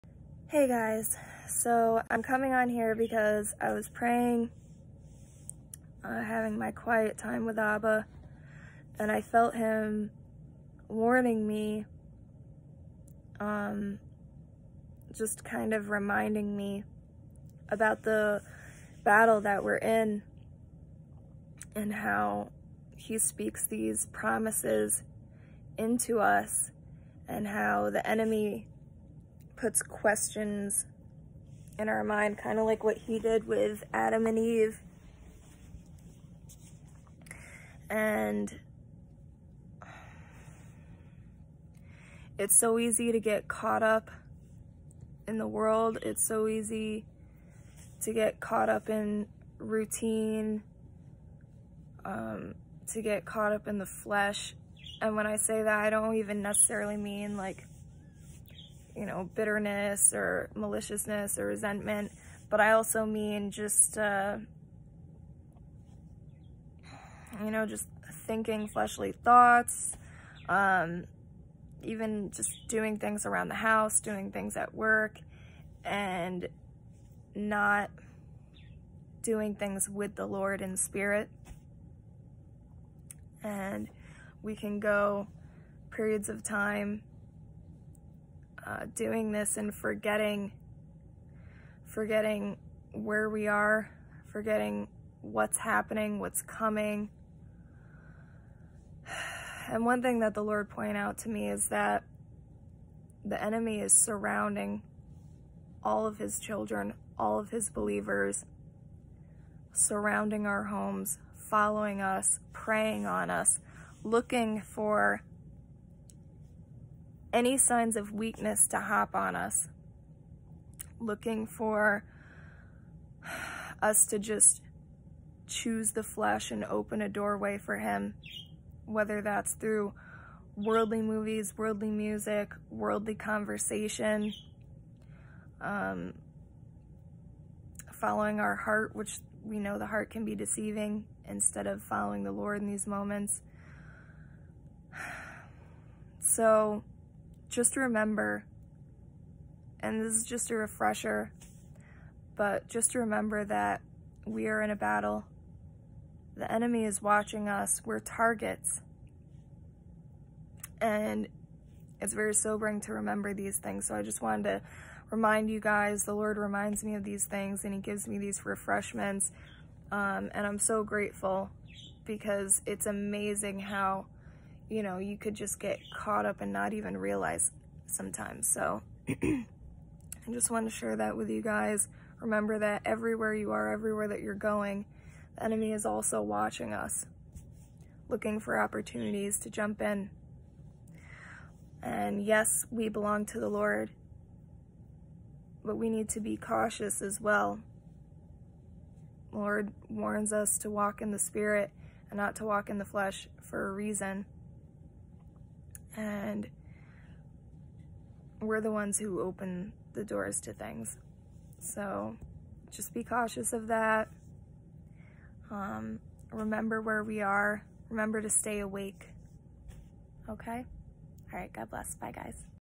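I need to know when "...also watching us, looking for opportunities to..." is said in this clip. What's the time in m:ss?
3:05.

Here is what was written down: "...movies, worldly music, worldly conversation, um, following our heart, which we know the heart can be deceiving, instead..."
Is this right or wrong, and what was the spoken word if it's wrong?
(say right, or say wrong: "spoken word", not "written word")
right.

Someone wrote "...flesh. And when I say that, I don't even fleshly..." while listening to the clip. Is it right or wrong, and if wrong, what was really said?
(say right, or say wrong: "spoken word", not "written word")
wrong: "necessarily", not "fleshly".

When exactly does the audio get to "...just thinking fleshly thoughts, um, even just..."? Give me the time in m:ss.
1:07.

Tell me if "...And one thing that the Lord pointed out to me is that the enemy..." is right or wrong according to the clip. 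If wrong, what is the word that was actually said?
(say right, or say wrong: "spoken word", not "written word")
right.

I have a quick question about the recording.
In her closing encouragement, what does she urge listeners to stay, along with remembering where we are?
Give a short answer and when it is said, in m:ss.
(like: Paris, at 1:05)
Awake, at 3:38.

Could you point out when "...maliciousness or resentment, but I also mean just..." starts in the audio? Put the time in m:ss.
1:00.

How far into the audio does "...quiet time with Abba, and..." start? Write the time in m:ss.
0:06.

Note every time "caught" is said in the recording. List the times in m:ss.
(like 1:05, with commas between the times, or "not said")
0:43, 0:48, 0:53, 2:55.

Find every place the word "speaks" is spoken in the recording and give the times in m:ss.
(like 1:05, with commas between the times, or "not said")
0:23.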